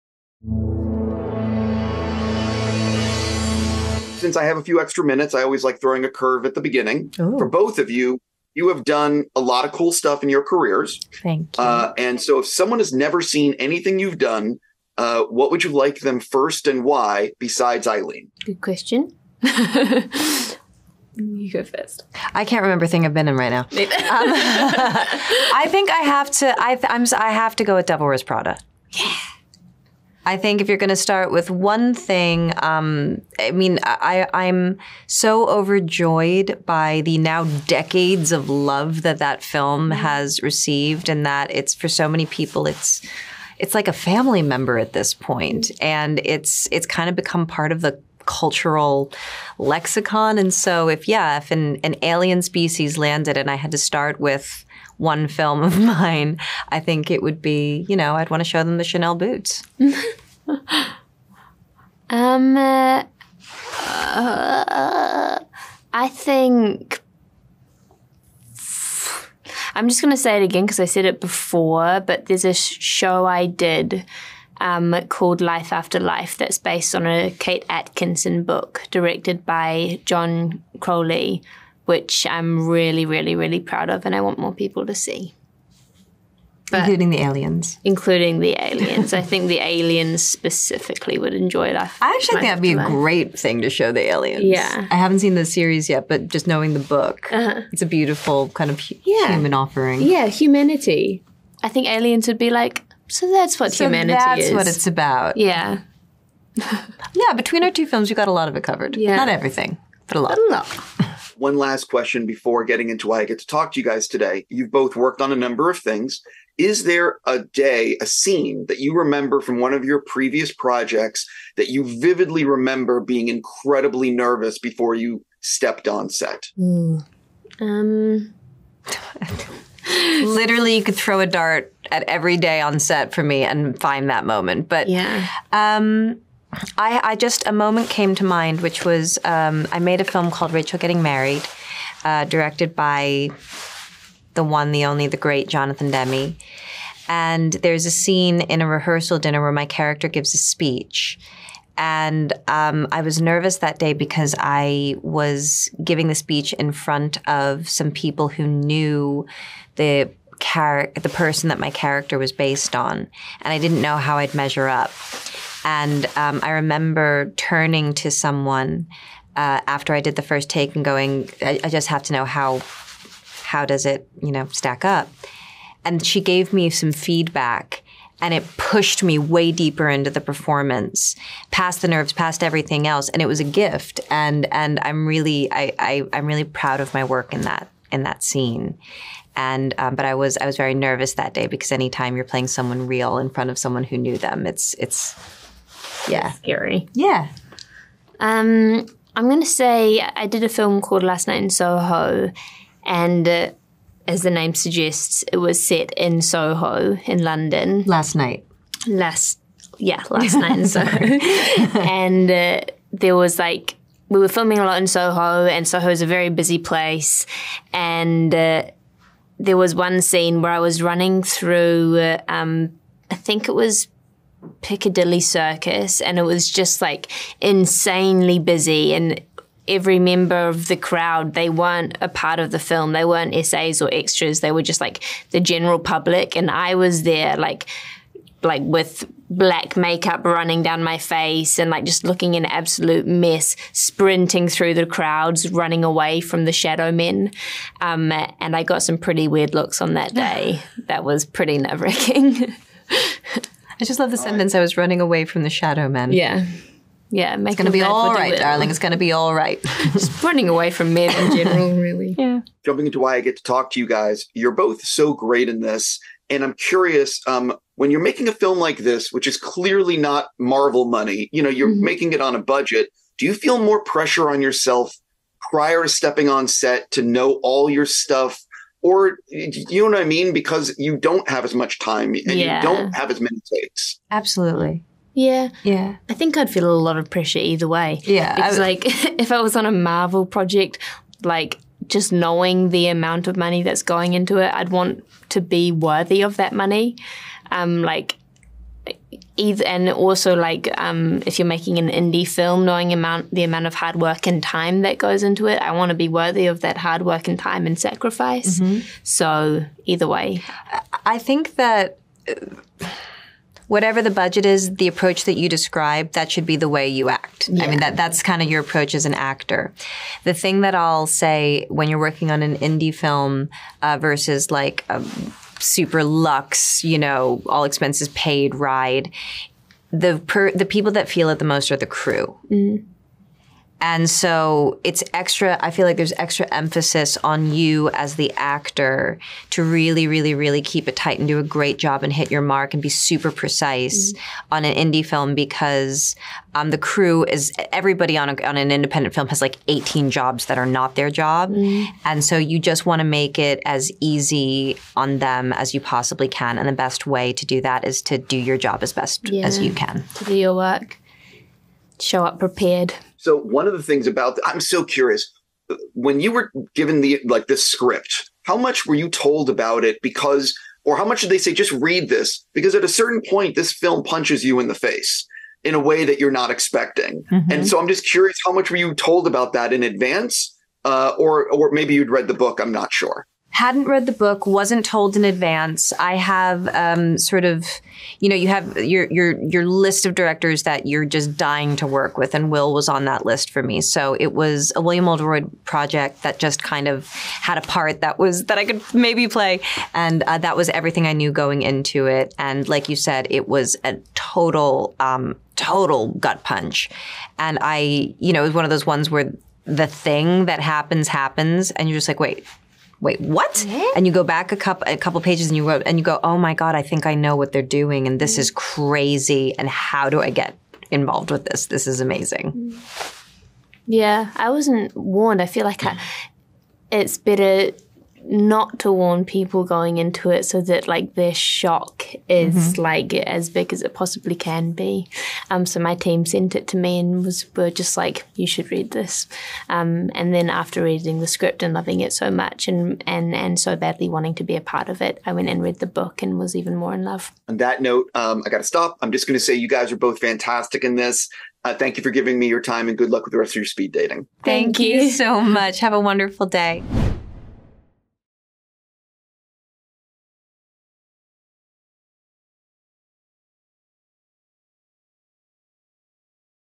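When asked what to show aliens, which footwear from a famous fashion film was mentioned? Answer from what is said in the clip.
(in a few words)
Chanel boots.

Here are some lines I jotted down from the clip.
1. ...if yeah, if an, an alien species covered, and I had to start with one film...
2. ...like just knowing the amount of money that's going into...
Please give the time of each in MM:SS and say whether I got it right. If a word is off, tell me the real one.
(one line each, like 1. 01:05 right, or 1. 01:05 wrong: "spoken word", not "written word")
1. 00:50 wrong: "landed", not "covered"
2. 04:51 right.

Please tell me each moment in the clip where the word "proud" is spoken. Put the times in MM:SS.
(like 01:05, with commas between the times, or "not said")
01:23, 03:06.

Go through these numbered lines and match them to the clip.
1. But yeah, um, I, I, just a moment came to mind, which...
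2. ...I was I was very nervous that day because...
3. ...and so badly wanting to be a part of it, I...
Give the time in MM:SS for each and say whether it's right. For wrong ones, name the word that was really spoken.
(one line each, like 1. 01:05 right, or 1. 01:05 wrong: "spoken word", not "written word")
1. 02:14 right
2. 03:10 right
3. 07:23 right.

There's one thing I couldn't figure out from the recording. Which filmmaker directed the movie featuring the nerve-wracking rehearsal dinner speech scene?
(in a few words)
Jonathan Demme.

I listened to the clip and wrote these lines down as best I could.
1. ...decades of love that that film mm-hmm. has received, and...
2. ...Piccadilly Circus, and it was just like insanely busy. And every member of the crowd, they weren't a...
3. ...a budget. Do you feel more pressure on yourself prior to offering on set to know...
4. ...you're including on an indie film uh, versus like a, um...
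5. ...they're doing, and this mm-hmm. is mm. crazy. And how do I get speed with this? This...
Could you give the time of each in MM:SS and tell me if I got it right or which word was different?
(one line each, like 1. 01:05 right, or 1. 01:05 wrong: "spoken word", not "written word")
1. 00:37 right
2. 03:44 right
3. 04:32 wrong: "stepping", not "offering"
4. 05:21 wrong: "working", not "including"
5. 06:57 wrong: "involved", not "speed".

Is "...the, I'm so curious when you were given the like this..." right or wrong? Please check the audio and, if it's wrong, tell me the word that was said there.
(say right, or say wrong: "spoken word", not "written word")
right.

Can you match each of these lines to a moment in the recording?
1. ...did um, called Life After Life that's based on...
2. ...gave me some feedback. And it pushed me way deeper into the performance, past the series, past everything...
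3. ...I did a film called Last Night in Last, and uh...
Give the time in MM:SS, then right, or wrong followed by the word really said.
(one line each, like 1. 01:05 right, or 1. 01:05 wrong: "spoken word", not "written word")
1. 01:13 right
2. 02:56 wrong: "nerves", not "series"
3. 03:19 wrong: "Soho", not "Last".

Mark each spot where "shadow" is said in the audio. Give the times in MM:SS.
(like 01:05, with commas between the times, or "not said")
04:06, 04:15.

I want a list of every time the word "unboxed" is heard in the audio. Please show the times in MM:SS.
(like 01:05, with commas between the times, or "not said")
not said.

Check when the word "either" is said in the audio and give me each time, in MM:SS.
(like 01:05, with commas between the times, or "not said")
04:47, 04:59, 05:09.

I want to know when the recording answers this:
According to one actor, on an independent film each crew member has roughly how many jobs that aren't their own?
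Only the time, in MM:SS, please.
05:49.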